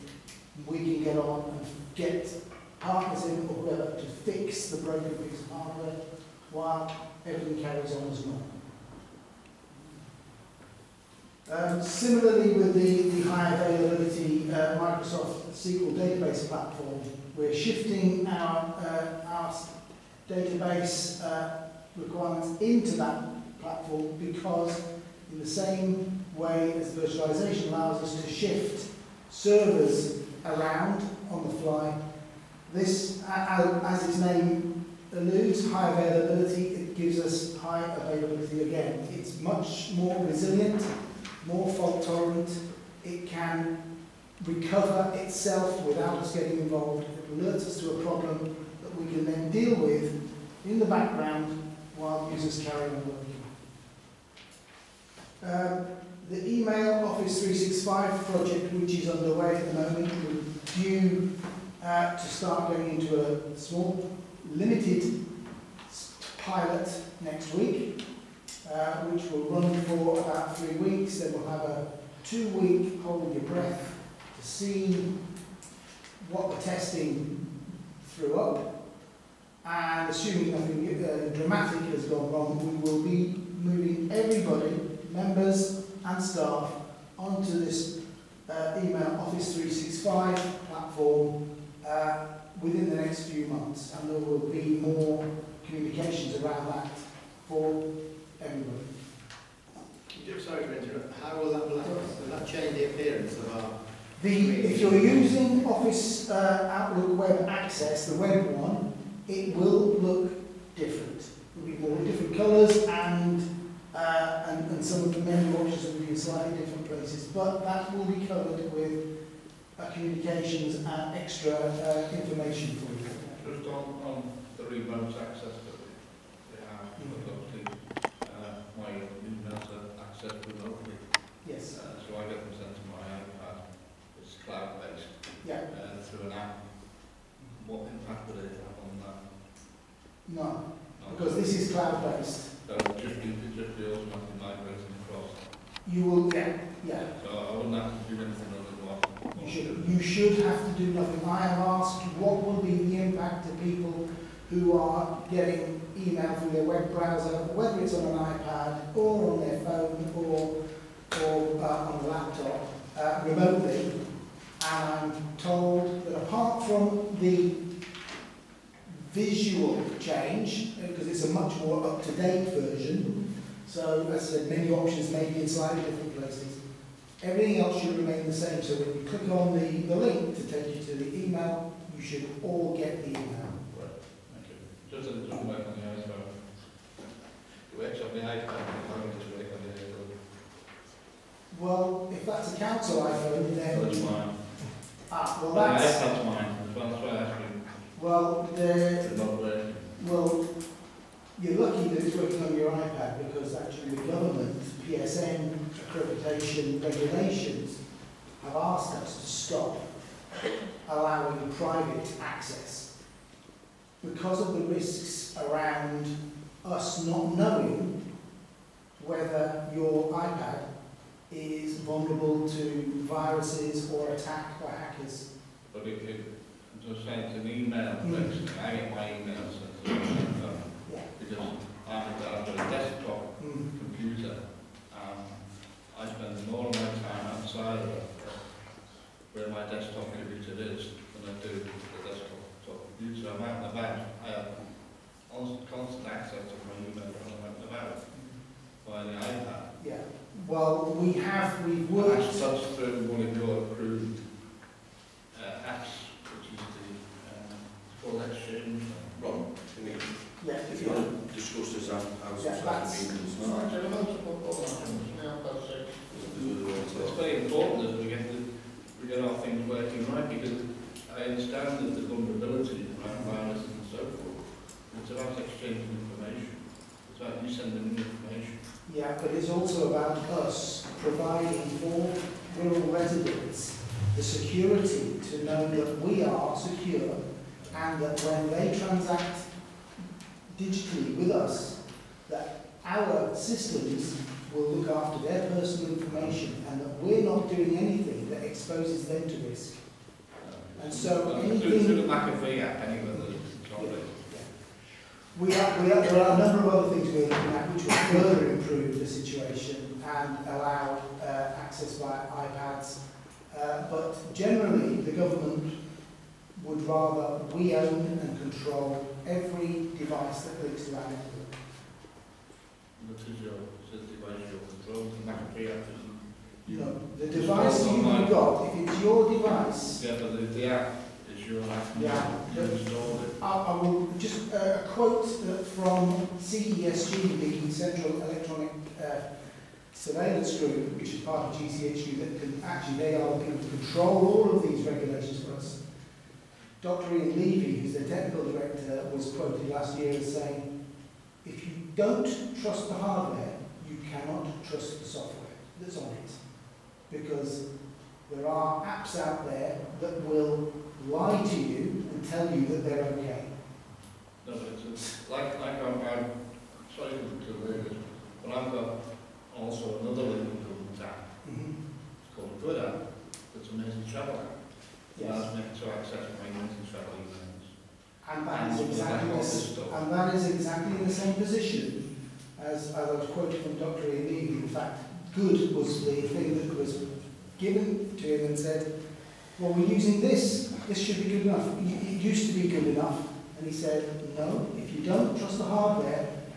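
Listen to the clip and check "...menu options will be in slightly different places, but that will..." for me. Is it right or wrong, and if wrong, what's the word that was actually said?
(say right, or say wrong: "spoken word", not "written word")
right.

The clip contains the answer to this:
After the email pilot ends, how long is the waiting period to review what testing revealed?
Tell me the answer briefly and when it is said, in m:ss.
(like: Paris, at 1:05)
2 weeks, at 1:12.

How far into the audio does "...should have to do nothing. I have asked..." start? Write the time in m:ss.
2:30.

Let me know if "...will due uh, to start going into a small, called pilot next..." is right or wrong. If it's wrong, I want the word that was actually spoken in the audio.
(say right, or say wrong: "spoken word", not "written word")
wrong: "limited", not "called".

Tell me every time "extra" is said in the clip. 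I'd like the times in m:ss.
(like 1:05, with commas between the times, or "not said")
2:01.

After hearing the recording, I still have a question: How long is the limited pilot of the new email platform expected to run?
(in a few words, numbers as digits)
about 3 weeks.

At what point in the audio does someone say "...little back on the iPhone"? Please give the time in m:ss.
3:05.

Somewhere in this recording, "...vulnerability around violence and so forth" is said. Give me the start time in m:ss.
4:32.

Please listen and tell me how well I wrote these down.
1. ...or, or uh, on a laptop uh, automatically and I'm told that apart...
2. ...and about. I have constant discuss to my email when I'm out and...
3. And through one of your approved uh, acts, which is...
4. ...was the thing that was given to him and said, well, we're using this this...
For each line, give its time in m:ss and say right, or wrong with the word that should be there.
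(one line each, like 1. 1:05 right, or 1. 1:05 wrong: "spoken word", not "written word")
1. 2:40 wrong: "remotely", not "automatically"
2. 4:03 wrong: "access", not "discuss"
3. 4:12 right
4. 6:25 right.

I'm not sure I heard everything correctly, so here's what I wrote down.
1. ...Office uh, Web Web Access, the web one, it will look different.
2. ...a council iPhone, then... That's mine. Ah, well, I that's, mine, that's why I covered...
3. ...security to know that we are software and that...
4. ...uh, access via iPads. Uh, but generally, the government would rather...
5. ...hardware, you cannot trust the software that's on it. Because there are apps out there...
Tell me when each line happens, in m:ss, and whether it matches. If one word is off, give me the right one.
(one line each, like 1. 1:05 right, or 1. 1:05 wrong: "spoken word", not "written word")
1. 1:45 wrong: "Outlook", not "Web"
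2. 3:12 wrong: "asked", not "covered"
3. 4:44 wrong: "secure", not "software"
4. 5:11 right
5. 5:52 right.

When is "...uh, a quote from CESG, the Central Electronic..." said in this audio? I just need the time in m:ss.
5:34.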